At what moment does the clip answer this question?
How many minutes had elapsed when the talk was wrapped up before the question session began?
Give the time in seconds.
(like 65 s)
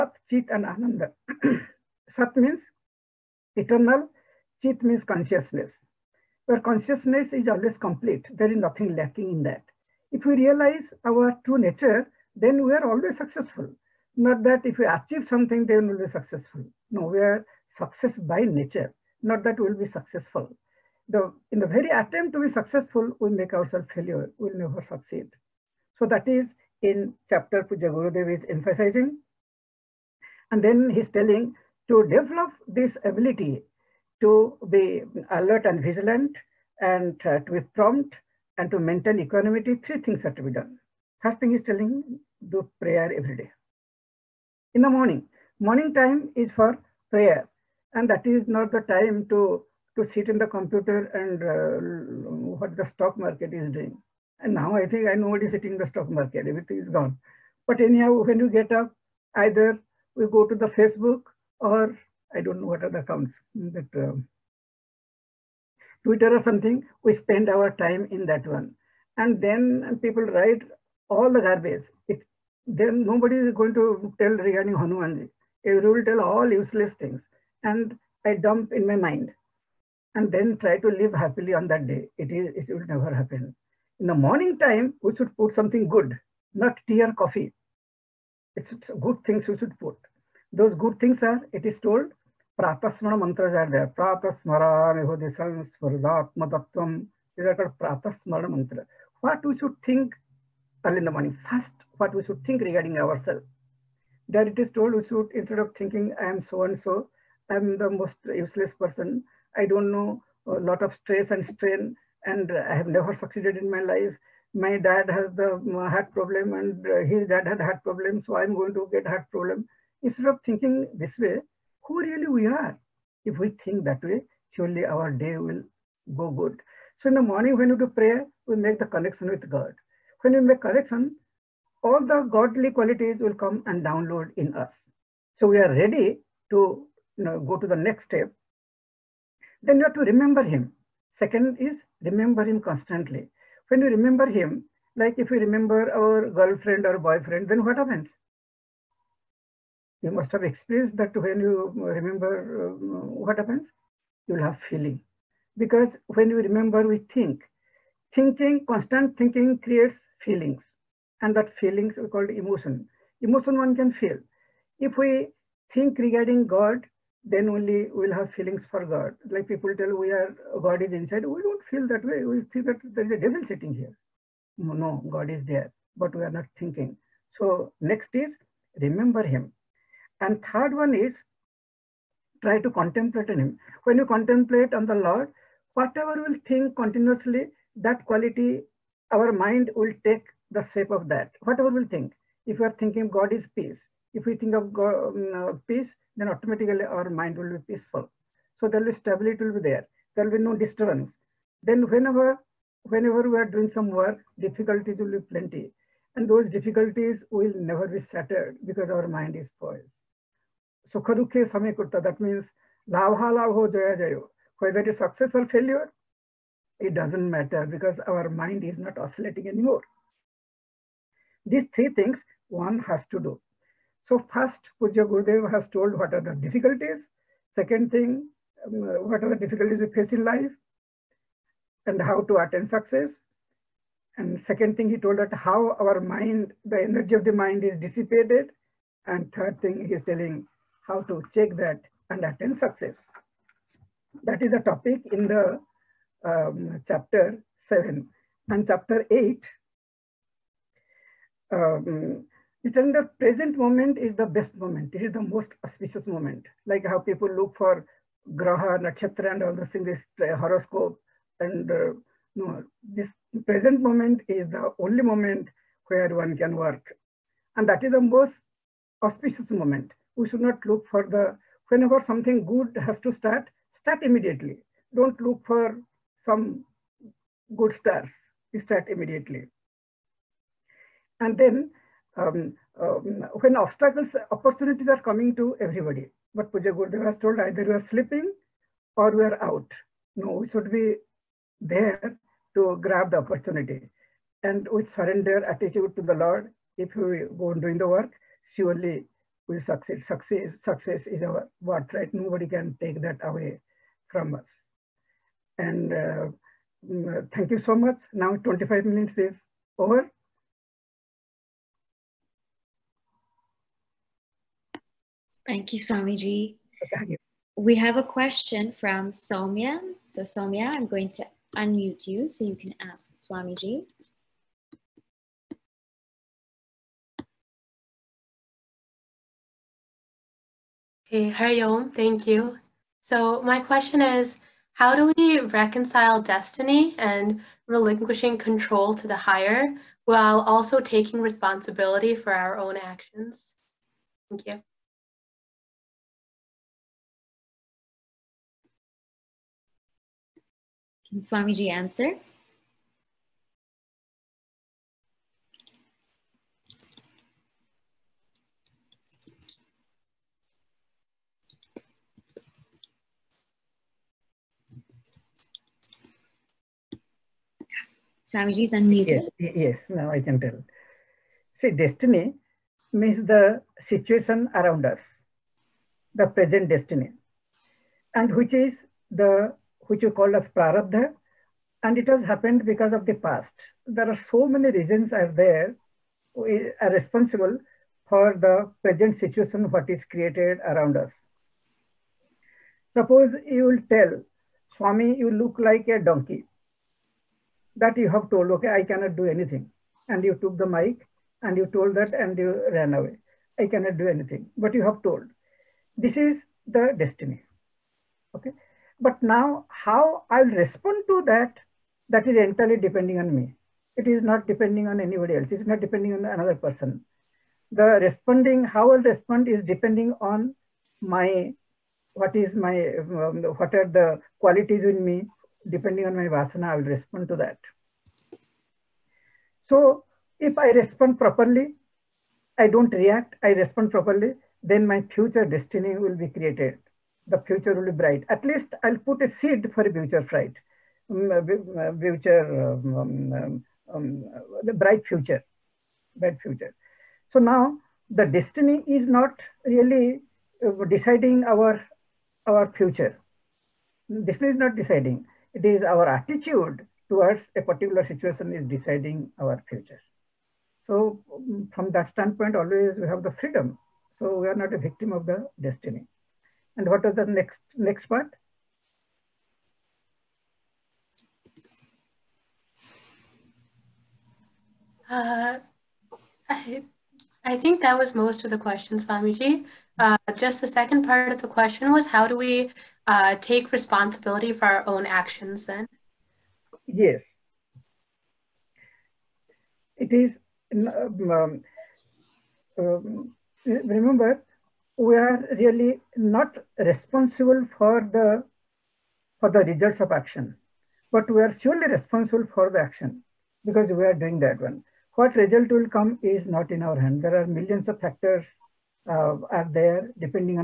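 308 s.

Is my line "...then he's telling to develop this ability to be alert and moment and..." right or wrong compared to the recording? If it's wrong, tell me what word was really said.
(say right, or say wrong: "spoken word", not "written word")
wrong: "vigilant", not "moment".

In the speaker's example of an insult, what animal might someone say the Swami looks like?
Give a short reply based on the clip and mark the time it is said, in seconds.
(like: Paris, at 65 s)
donkey, at 396 s.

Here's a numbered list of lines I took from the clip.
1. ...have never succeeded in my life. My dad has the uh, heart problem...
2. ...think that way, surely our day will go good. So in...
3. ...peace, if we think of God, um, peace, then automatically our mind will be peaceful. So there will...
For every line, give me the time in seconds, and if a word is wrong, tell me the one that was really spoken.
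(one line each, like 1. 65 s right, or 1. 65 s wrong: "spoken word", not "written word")
1. 112 s right
2. 123 s right
3. 193 s right.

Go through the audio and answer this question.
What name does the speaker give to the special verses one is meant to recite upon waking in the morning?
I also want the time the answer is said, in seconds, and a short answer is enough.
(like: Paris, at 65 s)
Pratasmana mantras, at 92 s.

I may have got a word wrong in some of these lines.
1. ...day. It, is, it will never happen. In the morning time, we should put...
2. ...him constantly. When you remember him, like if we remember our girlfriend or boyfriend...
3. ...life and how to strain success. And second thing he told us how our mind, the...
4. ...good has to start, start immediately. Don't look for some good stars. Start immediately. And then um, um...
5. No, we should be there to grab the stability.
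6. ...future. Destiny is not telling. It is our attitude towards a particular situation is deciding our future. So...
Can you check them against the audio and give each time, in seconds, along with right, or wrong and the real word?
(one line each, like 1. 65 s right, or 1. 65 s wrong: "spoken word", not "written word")
1. 81 s right
2. 142 s right
3. 230 s wrong: "attain", not "strain"
4. 272 s right
5. 290 s wrong: "opportunity", not "stability"
6. 452 s wrong: "deciding", not "telling".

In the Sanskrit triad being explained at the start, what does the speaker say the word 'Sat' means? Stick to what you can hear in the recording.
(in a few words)
eternal.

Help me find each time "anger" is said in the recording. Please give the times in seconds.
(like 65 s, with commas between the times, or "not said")
not said.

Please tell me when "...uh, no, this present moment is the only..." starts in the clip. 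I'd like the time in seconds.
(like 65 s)
261 s.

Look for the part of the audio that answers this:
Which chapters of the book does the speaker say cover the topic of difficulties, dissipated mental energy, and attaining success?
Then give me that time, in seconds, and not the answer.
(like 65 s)
246 s.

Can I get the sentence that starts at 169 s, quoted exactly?
Like people tell we are God is inside.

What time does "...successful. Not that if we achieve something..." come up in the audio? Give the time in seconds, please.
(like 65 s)
13 s.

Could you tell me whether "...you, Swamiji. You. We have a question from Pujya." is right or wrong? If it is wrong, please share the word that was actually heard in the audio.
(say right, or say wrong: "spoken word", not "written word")
wrong: "Somia", not "Pujya".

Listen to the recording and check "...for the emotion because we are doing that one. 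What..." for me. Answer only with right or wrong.
wrong.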